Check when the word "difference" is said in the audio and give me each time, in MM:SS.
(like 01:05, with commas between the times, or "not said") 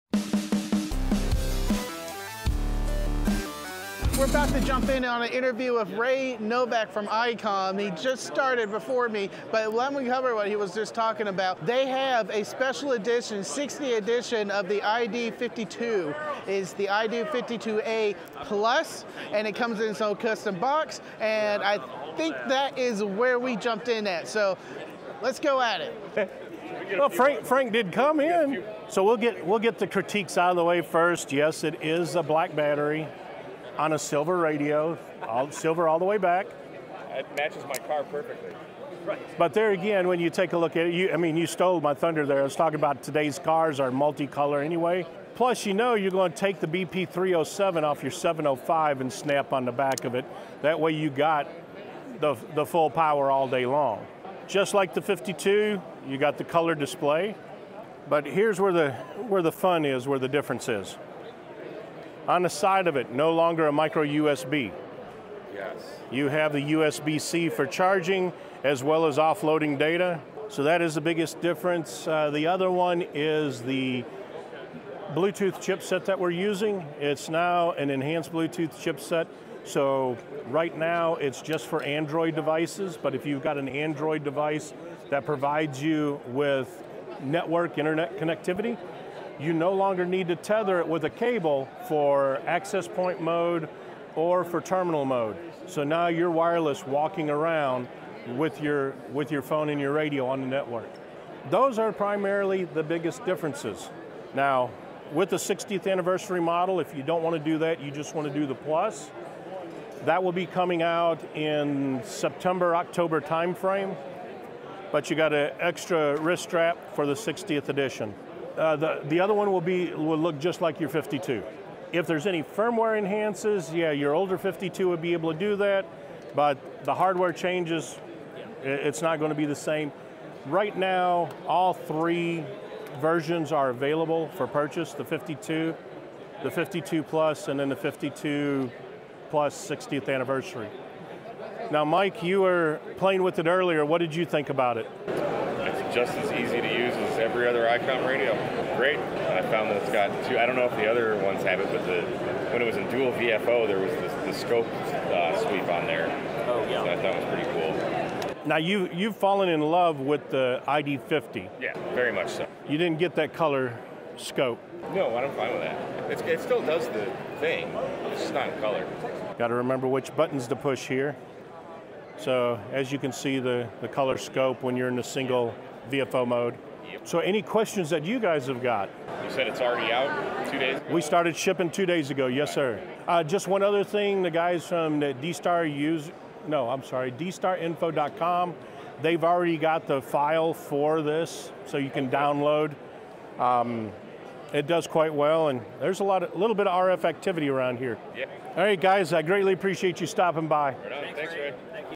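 01:00, 01:11, 01:43.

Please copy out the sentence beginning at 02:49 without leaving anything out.
Got to remember which buttons to push here.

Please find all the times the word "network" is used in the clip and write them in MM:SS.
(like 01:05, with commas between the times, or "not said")
01:27, 01:40.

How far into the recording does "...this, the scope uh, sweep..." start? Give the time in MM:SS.
02:33.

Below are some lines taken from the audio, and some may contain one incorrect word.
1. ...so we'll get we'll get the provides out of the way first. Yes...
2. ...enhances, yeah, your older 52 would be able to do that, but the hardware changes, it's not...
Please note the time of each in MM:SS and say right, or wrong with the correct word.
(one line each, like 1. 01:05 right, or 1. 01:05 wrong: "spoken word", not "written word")
1. 00:28 wrong: "critiques", not "provides"
2. 02:02 right.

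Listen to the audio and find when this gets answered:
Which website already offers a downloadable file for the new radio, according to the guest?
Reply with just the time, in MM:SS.
03:07.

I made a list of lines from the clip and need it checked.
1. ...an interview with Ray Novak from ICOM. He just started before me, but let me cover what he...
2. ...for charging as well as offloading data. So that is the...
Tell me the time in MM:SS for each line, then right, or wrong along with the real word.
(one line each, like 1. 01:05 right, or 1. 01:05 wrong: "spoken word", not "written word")
1. 00:05 right
2. 01:07 right.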